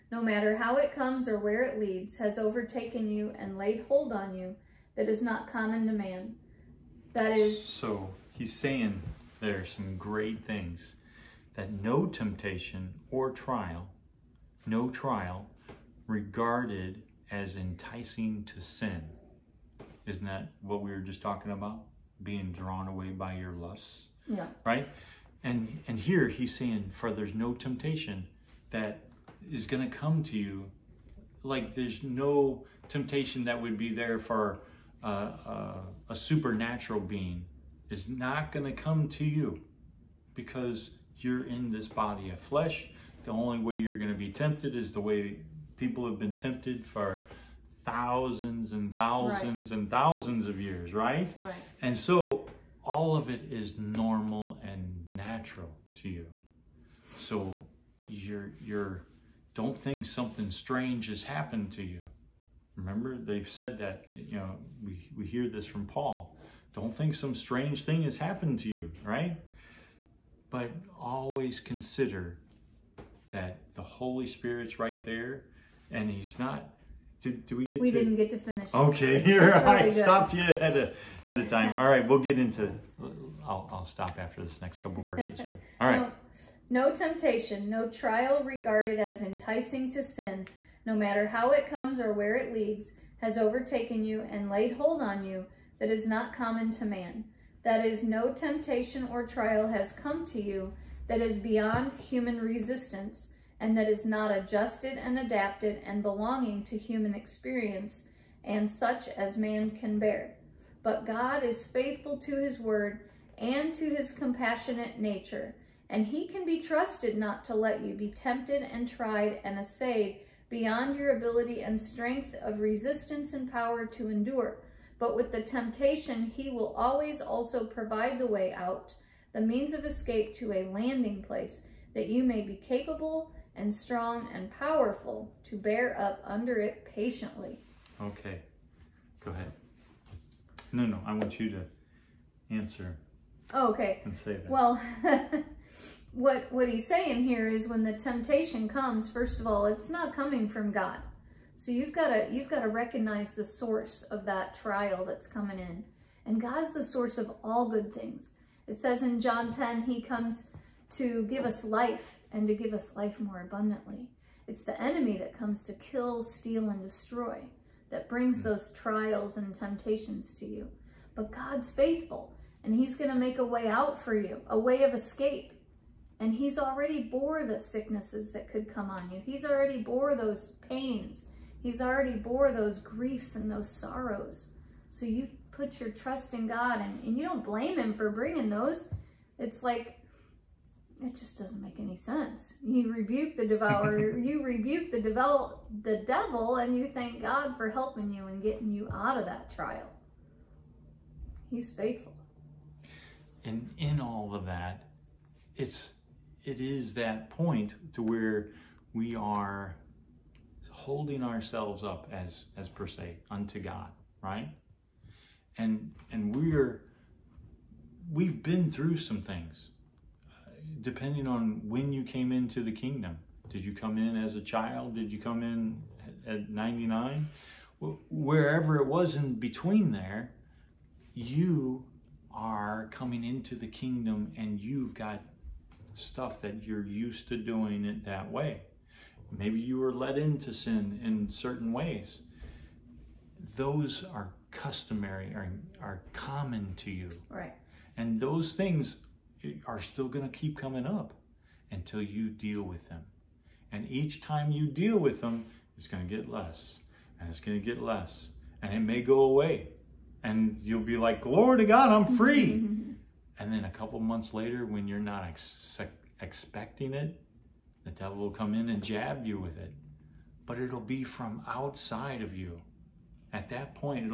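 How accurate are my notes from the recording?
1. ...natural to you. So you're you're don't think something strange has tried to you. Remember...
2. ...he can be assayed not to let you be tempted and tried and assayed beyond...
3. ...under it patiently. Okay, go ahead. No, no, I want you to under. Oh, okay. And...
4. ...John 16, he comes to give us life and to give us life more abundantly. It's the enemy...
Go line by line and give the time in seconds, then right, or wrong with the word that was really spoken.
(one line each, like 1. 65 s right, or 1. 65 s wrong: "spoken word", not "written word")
1. 55 s wrong: "happened", not "tried"
2. 116 s wrong: "trusted", not "assayed"
3. 136 s wrong: "answer", not "under"
4. 159 s wrong: "10", not "16".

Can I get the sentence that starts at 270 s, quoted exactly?
But it'll be from outside of you.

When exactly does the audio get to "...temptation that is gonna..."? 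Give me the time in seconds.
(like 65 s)
27 s.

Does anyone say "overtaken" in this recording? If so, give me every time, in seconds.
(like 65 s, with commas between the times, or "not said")
2 s, 93 s.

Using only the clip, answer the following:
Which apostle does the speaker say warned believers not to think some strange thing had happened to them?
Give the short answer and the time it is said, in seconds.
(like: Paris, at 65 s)
Paul, at 65 s.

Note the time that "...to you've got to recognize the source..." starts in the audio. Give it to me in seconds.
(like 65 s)
152 s.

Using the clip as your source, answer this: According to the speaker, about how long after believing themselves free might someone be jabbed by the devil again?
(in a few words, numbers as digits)
A couple months.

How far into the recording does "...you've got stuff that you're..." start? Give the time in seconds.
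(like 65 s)
234 s.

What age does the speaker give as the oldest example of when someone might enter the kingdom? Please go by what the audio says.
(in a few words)
99.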